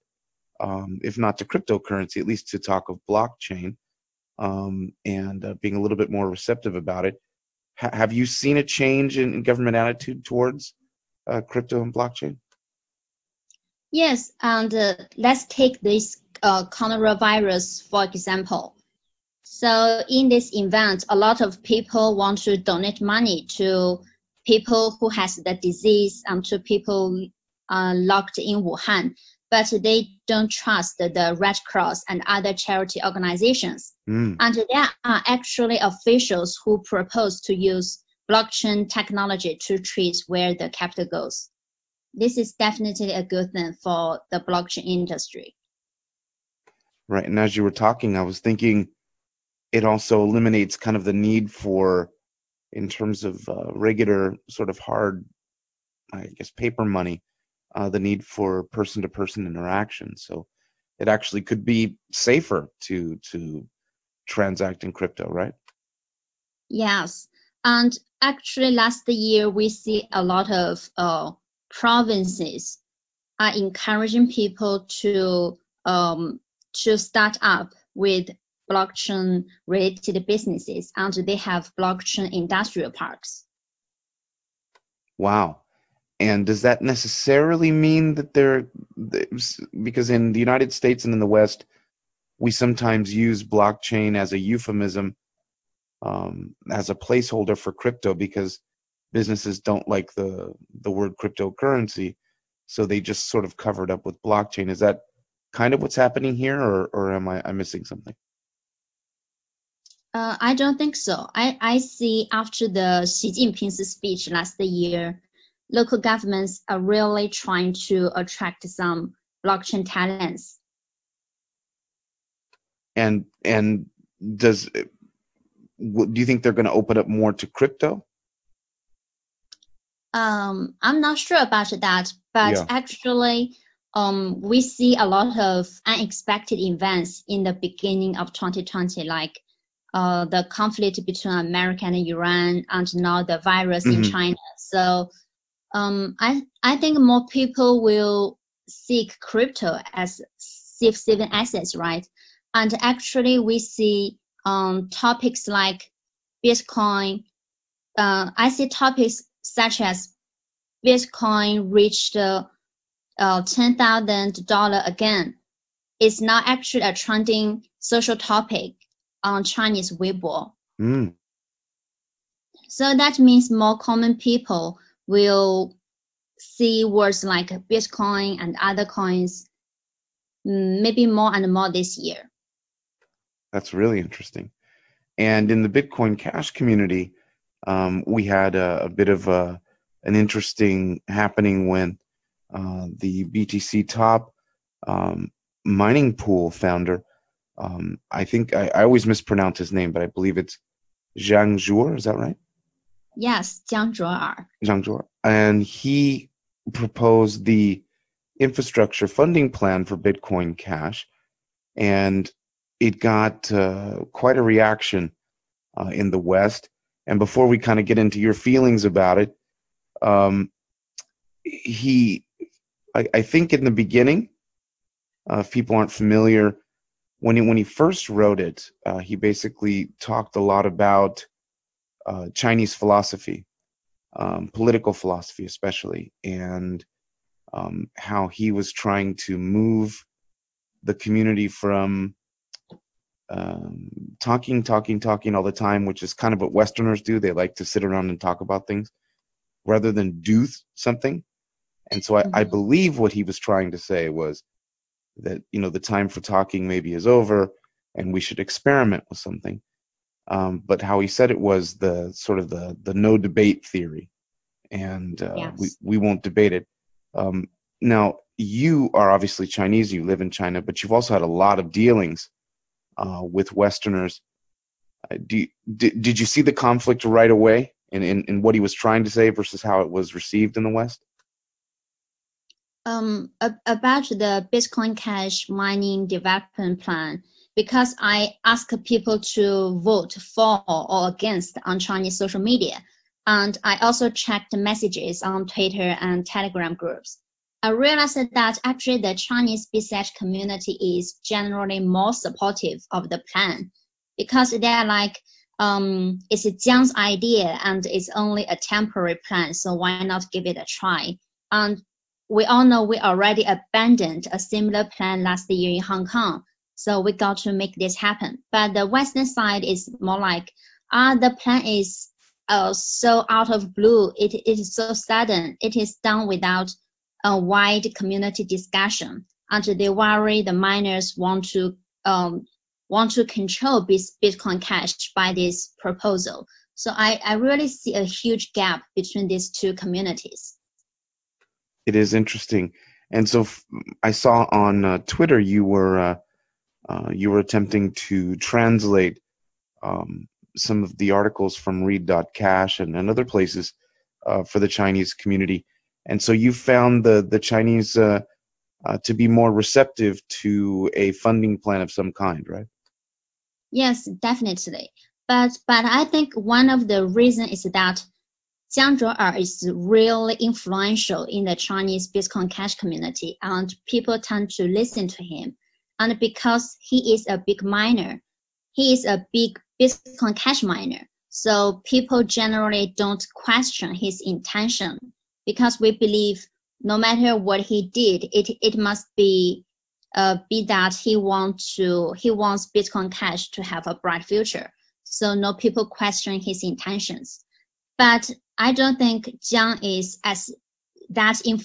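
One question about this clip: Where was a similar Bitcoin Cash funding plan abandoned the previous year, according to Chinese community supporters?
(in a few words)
Hong Kong.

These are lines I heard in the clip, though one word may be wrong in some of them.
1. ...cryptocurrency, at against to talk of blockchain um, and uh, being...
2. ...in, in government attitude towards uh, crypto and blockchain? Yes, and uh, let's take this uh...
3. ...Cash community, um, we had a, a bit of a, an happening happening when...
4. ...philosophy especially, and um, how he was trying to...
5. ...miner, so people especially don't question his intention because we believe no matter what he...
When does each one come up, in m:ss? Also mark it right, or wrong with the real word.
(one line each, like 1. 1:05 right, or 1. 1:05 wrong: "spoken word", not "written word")
1. 0:01 wrong: "least", not "against"
2. 0:09 right
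3. 3:06 wrong: "interesting", not "happening"
4. 3:54 right
5. 6:20 wrong: "generally", not "especially".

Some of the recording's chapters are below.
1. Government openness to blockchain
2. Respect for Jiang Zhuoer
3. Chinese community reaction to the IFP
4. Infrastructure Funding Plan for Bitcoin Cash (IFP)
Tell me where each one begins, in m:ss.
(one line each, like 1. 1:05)
1. 0:16
2. 6:06
3. 4:46
4. 3:21.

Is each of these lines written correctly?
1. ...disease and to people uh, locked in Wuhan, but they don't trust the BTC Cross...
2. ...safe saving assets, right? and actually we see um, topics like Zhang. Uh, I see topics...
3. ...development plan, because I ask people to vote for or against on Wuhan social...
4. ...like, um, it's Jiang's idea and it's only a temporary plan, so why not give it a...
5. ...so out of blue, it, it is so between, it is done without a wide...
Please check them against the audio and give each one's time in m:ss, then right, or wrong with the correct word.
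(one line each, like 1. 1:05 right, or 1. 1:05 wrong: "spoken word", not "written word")
1. 0:25 wrong: "Red", not "BTC"
2. 2:30 wrong: "Bitcoin", not "Zhang"
3. 4:46 wrong: "Chinese", not "Wuhan"
4. 5:04 right
5. 5:22 wrong: "sudden", not "between".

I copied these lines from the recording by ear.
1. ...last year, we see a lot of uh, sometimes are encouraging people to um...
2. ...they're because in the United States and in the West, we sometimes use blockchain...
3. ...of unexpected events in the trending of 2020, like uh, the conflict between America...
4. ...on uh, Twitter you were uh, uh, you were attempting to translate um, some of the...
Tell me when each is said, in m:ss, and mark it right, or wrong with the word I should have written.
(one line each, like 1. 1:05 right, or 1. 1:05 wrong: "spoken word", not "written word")
1. 1:08 wrong: "provinces", not "sometimes"
2. 1:28 right
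3. 2:15 wrong: "beginning", not "trending"
4. 5:44 right.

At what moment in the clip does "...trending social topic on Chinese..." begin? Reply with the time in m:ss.
2:46.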